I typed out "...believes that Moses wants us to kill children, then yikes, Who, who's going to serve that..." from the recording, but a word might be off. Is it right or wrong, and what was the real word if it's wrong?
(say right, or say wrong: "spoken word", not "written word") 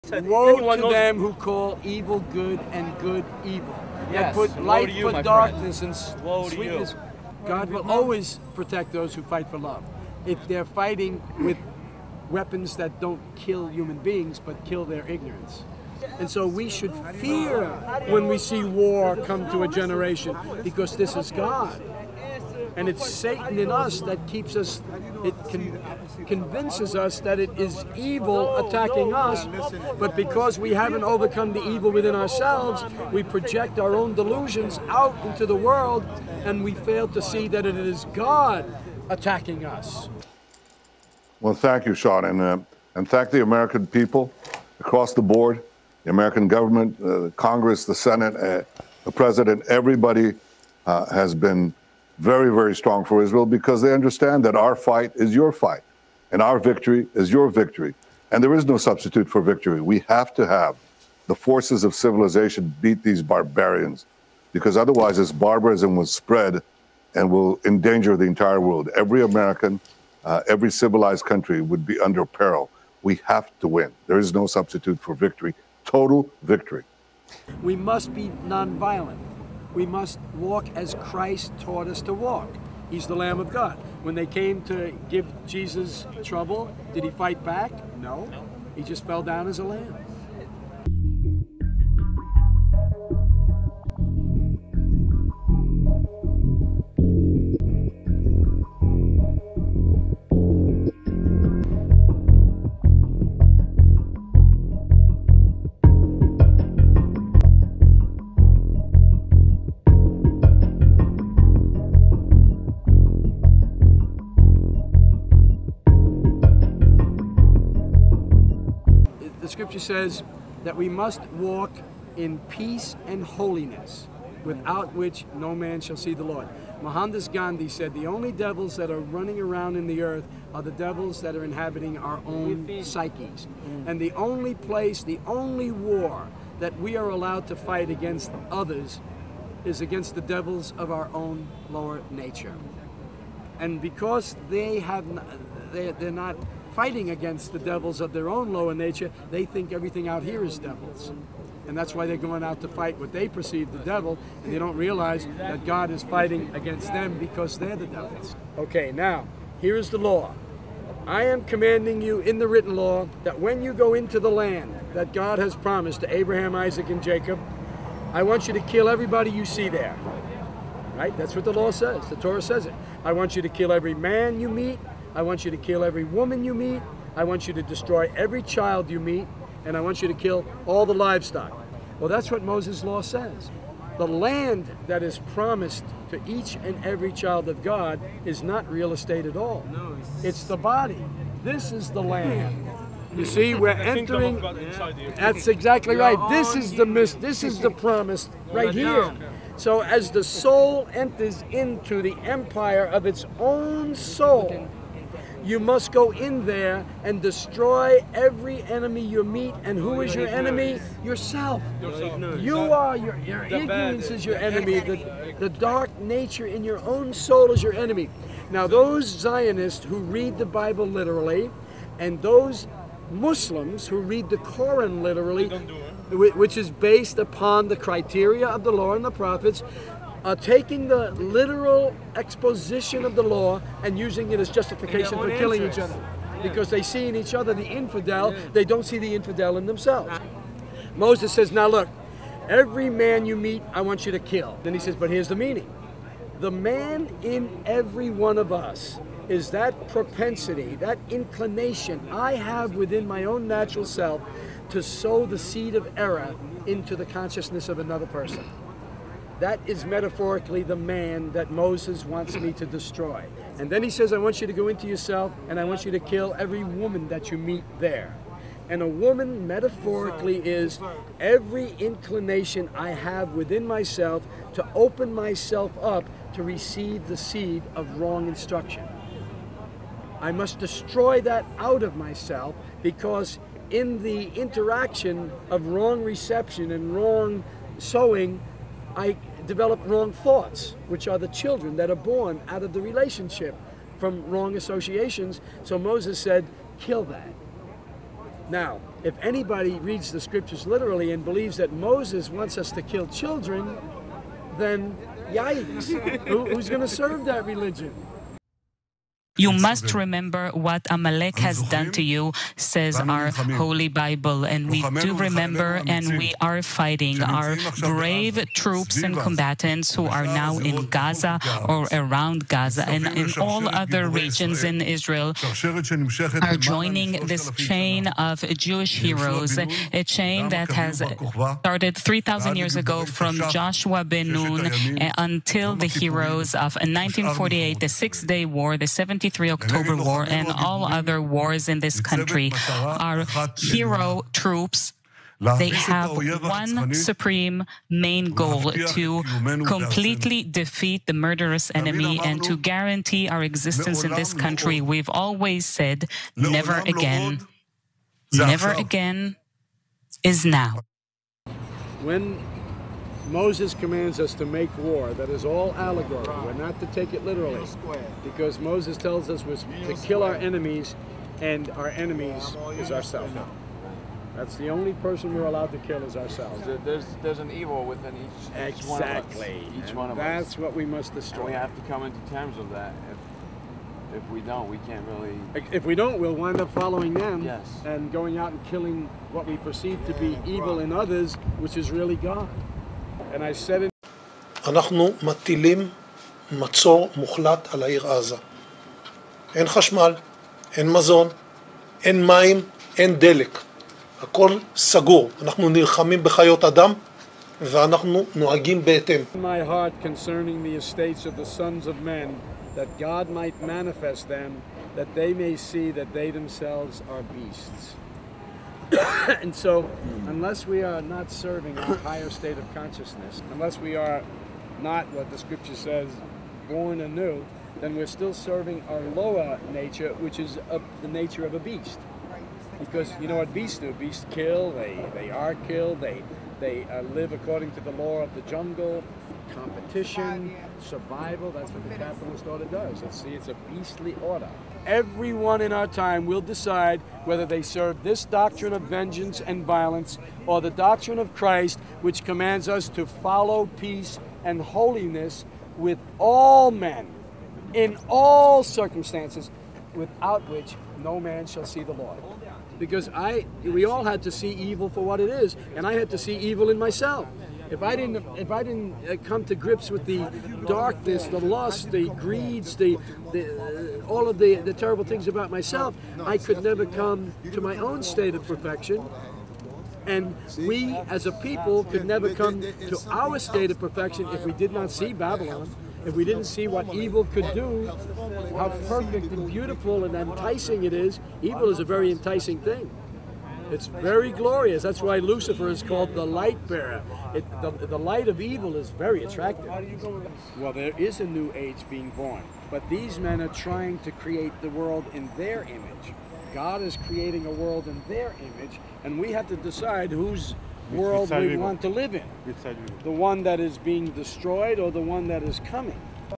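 right.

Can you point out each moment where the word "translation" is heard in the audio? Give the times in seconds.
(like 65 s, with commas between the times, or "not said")
not said.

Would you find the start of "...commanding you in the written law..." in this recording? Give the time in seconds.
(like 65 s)
161 s.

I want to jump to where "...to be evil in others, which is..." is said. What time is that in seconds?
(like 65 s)
390 s.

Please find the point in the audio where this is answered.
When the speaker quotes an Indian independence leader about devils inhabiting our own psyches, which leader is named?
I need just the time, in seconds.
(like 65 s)
126 s.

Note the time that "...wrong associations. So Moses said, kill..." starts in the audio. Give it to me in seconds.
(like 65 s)
294 s.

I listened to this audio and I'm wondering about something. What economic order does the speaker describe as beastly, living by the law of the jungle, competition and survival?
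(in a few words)
capitalist order.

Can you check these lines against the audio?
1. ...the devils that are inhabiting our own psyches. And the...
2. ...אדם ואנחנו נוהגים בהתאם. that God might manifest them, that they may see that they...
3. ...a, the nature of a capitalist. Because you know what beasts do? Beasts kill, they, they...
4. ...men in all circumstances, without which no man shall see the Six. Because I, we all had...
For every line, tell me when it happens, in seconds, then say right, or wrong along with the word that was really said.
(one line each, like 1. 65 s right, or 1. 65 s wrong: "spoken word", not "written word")
1. 130 s right
2. 406 s right
3. 430 s wrong: "beast", not "capitalist"
4. 456 s wrong: "Lord", not "Six".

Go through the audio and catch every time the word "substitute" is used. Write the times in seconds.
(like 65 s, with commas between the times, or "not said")
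58 s, 74 s.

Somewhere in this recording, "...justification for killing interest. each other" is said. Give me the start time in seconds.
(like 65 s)
234 s.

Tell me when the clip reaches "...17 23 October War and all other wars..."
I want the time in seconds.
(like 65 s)
338 s.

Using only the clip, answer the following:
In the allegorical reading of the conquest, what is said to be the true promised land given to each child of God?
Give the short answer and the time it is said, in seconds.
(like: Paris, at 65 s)
The body, at 190 s.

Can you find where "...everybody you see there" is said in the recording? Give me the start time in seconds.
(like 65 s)
168 s.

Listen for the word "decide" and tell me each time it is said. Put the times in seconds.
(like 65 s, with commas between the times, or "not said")
446 s, 509 s.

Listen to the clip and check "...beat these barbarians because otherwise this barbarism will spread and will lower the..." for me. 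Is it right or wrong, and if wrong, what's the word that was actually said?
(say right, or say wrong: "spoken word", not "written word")
wrong: "endanger", not "lower".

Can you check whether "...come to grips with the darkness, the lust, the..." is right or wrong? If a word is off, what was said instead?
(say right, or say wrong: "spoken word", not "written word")
right.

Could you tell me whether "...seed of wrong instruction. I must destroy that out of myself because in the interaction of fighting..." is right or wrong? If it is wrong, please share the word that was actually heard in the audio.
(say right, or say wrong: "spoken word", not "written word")
wrong: "wrong", not "fighting".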